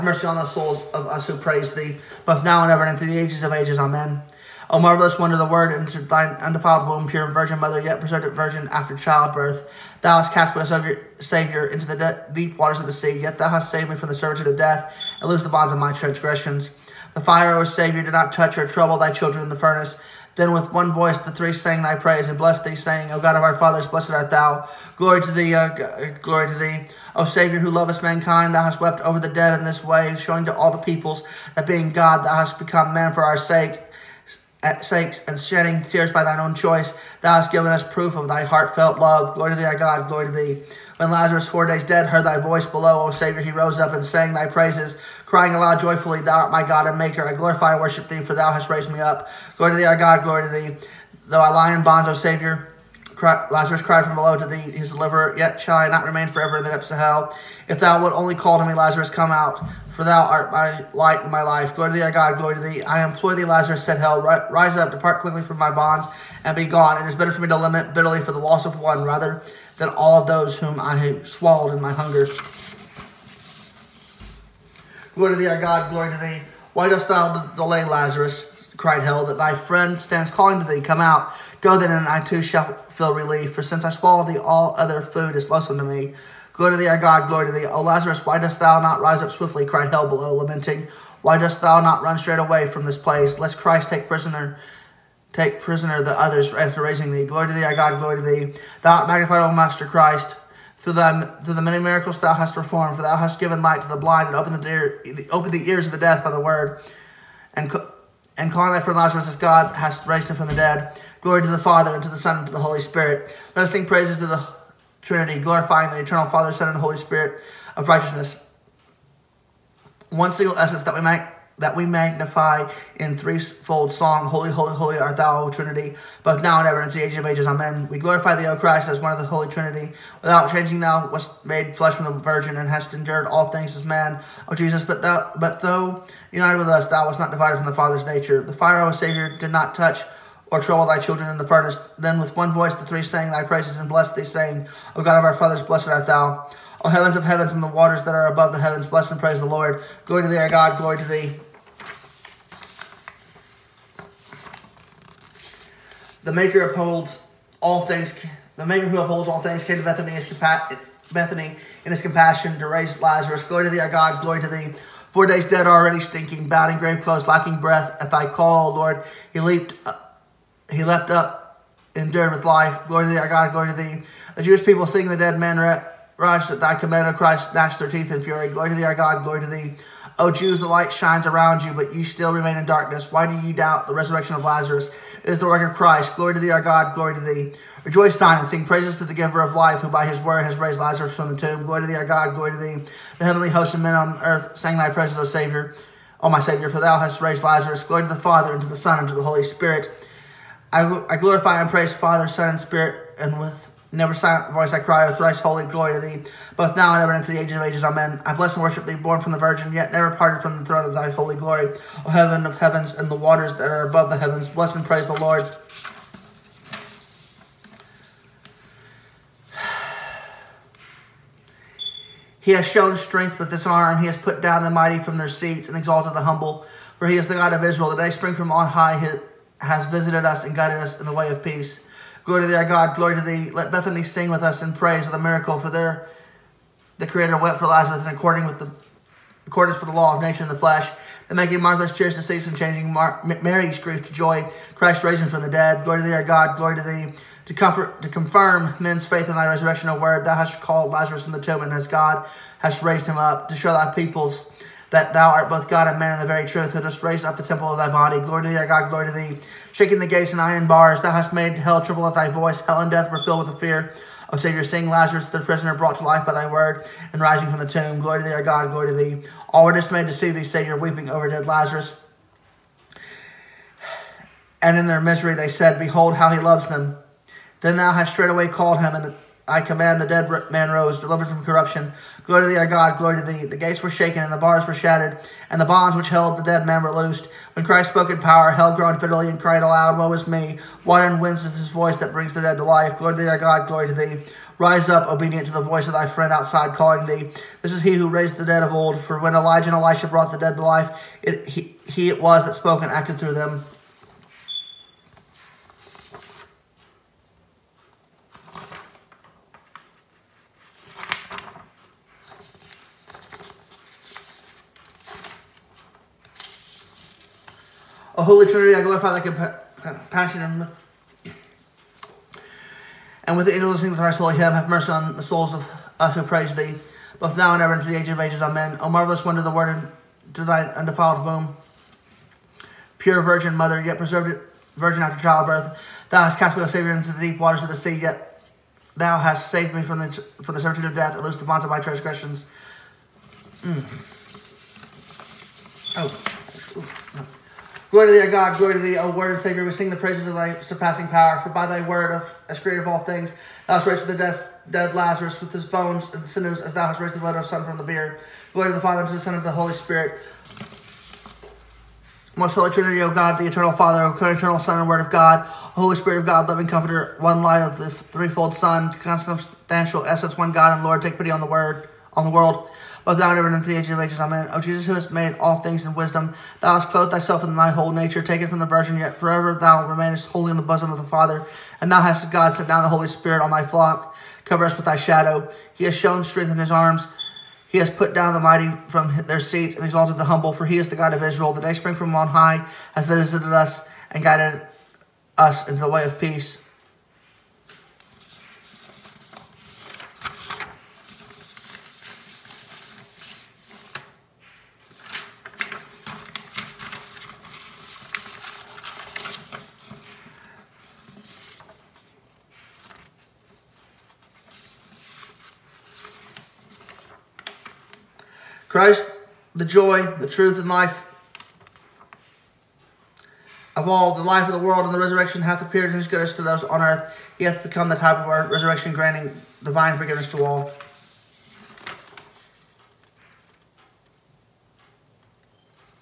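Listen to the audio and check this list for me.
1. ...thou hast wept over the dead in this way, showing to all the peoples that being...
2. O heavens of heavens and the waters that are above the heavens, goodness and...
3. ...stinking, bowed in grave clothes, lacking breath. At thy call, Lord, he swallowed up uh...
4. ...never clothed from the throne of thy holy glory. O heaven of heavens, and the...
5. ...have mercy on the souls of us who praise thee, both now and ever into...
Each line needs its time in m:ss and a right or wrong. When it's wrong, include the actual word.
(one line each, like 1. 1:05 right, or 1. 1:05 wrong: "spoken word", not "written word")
1. 0:28 right
2. 2:26 wrong: "bless", not "goodness"
3. 2:45 wrong: "leaped", not "swallowed"
4. 3:29 wrong: "parted", not "clothed"
5. 5:24 right.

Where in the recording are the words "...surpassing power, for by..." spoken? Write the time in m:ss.
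5:50.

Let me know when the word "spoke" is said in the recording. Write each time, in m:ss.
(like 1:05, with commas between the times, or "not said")
4:47, 5:02.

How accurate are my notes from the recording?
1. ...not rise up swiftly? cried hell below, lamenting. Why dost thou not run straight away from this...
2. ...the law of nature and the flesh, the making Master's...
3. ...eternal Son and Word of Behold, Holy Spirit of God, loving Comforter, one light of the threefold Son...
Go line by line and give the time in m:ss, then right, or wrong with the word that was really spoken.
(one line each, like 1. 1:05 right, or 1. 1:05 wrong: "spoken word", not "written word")
1. 1:28 right
2. 3:59 wrong: "Martha", not "Master"
3. 6:04 wrong: "God", not "Behold".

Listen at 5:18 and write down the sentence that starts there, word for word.
O Holy Trinity, I glorify thy compassion.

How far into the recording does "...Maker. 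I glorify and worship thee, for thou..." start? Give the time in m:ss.
0:46.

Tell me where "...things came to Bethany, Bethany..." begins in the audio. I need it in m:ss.
2:39.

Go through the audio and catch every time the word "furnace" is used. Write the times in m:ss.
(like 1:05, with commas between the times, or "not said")
0:19, 2:21.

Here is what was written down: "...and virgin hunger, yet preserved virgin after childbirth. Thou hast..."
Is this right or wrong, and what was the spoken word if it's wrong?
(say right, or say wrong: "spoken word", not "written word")
wrong: "mother", not "hunger".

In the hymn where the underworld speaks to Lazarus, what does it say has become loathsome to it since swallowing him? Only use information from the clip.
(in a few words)
All other food.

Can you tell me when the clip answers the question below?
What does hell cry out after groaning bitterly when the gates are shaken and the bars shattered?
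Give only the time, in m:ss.
4:49.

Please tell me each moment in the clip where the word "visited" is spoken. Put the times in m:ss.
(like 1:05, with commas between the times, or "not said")
3:49, 6:33.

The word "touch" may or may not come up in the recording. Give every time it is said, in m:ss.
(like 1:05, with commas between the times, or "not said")
0:18, 2:19.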